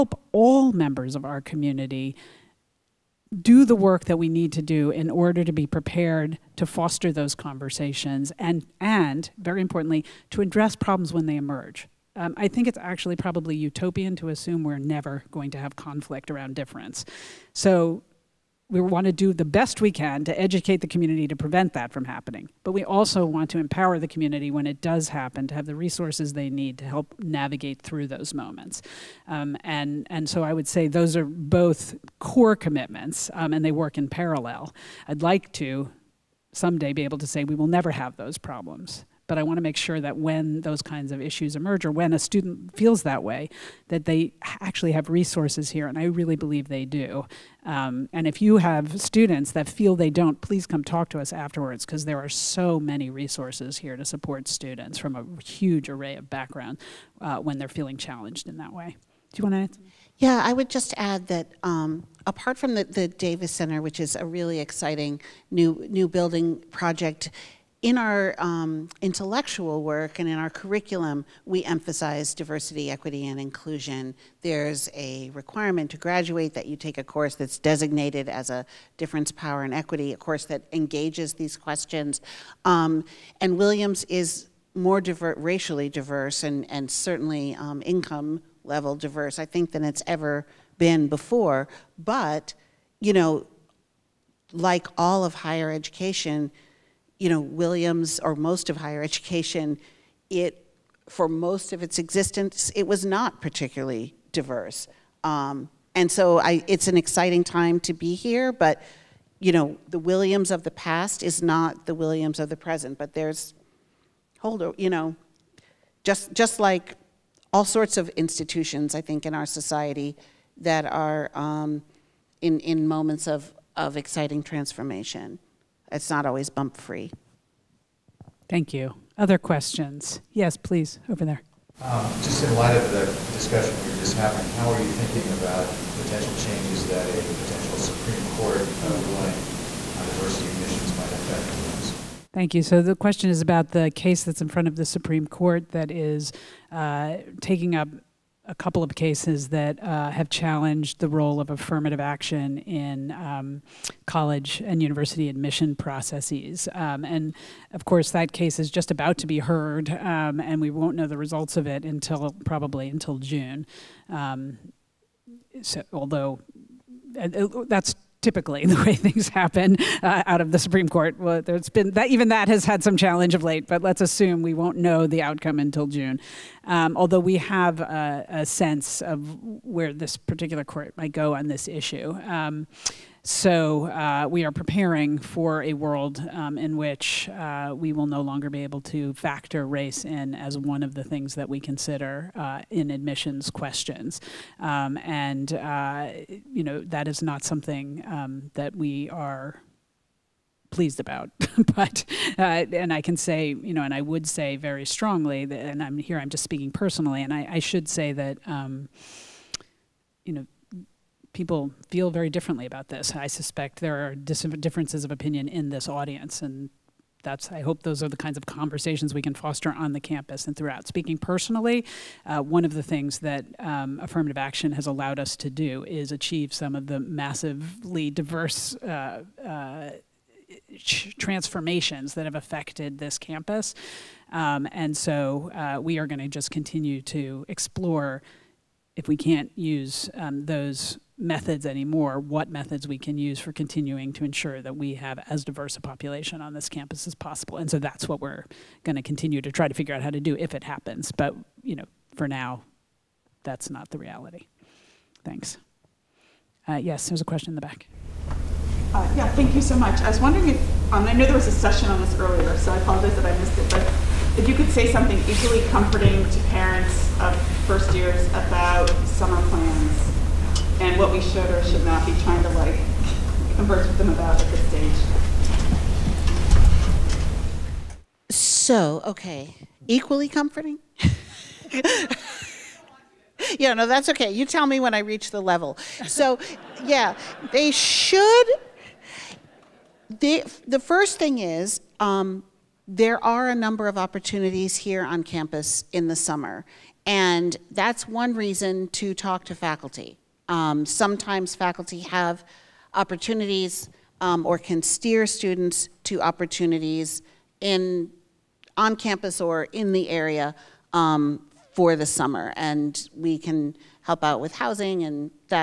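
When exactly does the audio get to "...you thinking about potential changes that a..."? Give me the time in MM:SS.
02:14.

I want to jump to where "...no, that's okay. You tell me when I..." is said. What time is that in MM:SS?
04:43.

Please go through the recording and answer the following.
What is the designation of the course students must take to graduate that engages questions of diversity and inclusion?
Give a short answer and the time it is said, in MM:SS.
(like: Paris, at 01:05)
difference, power, and equity, at 01:18.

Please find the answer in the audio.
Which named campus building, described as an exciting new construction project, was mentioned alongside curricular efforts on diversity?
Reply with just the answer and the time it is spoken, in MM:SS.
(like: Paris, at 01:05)
Davis Center, at 01:03.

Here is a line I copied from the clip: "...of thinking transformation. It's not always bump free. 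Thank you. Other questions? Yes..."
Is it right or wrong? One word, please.
wrong.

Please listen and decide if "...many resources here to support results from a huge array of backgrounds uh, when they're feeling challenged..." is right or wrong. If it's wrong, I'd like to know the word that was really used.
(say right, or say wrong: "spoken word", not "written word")
wrong: "students", not "results".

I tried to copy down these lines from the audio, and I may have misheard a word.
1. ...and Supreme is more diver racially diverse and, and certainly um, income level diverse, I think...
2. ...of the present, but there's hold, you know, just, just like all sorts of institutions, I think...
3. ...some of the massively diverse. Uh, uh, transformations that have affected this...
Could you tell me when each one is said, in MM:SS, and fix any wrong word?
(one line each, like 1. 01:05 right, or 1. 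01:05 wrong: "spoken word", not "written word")
1. 01:23 wrong: "Williams", not "Supreme"
2. 01:52 right
3. 03:46 right.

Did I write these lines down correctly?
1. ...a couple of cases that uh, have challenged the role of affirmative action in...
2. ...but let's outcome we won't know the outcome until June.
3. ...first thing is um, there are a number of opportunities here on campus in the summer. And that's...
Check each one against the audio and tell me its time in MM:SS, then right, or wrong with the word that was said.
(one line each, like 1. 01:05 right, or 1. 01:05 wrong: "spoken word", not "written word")
1. 02:28 right
2. 02:53 wrong: "assume", not "outcome"
3. 04:50 right.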